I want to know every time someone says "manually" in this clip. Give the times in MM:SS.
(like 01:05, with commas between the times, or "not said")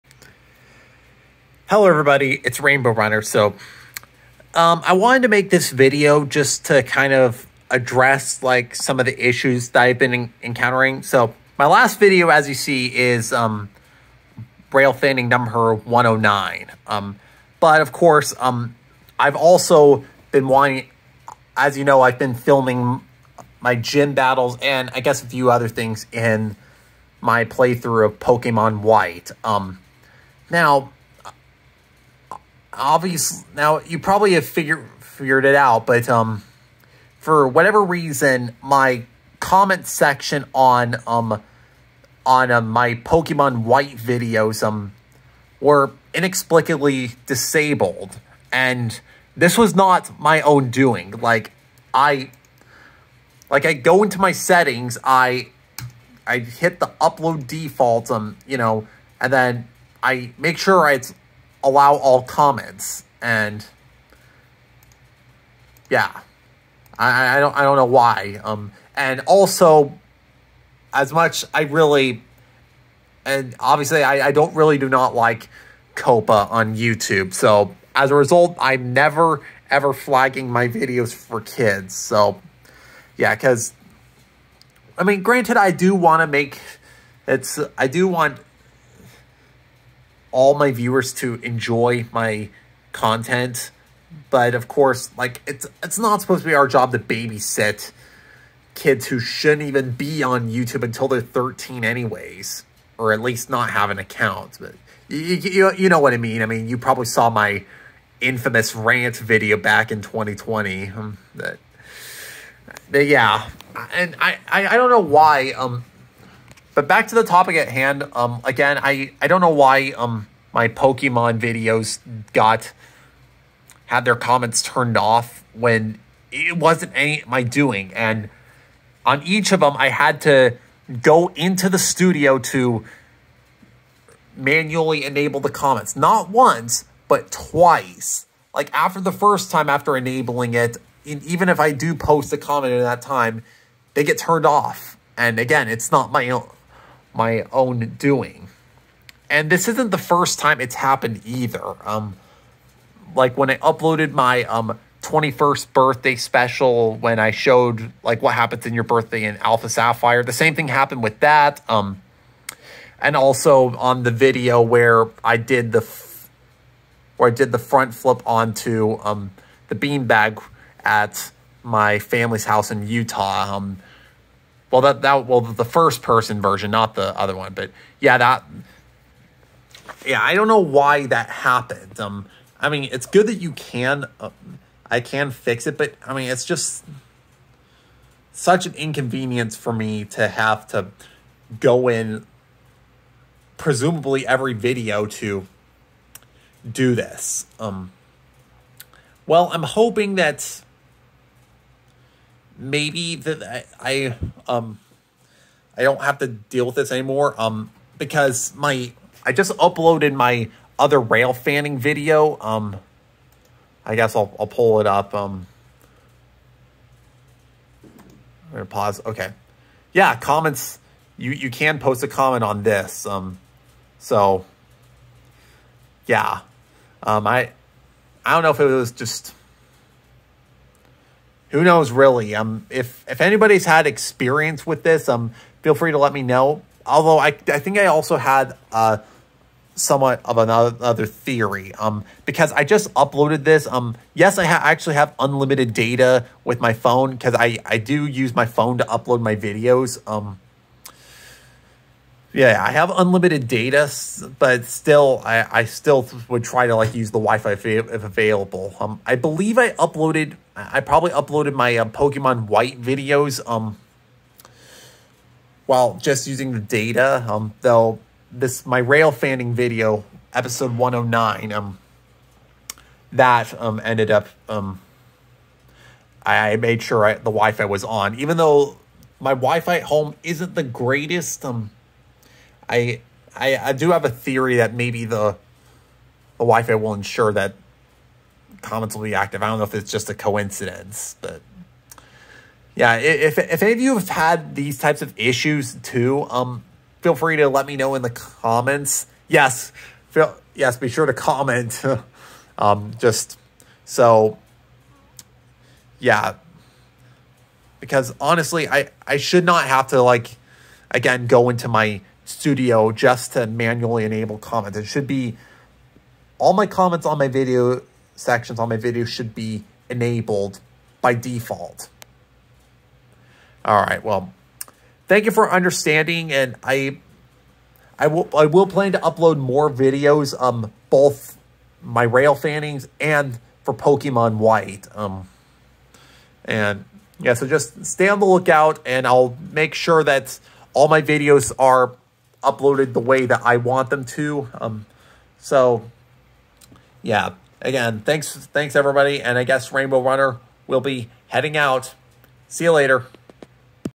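02:14, 05:13.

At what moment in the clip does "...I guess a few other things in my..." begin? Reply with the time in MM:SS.
00:24.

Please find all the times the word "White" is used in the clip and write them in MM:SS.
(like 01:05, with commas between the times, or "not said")
00:28, 00:43, 04:22, 05:34.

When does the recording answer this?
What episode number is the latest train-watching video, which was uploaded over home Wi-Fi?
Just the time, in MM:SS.
04:30.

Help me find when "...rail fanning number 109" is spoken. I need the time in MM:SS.
00:14.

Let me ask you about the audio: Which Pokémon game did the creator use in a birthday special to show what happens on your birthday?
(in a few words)
Alpha Sapphire.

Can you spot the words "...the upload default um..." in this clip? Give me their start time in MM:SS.
00:56.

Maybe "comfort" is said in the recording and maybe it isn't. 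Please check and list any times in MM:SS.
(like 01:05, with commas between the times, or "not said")
not said.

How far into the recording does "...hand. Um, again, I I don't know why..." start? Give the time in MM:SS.
01:57.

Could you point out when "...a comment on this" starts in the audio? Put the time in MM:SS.
03:42.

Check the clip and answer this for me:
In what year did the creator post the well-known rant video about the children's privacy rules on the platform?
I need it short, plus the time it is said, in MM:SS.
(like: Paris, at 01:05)
2020, at 01:50.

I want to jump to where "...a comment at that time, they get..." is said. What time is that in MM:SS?
02:22.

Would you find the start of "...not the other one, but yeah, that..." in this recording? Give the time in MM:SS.
02:56.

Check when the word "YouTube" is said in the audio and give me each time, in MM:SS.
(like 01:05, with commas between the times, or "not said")
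01:16, 01:40.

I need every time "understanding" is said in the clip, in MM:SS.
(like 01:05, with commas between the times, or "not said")
05:25.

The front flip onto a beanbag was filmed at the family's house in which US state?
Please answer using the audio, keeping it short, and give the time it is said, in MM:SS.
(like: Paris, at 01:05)
Utah, at 02:52.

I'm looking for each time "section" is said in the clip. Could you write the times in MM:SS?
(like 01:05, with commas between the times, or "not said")
00:39, 05:18.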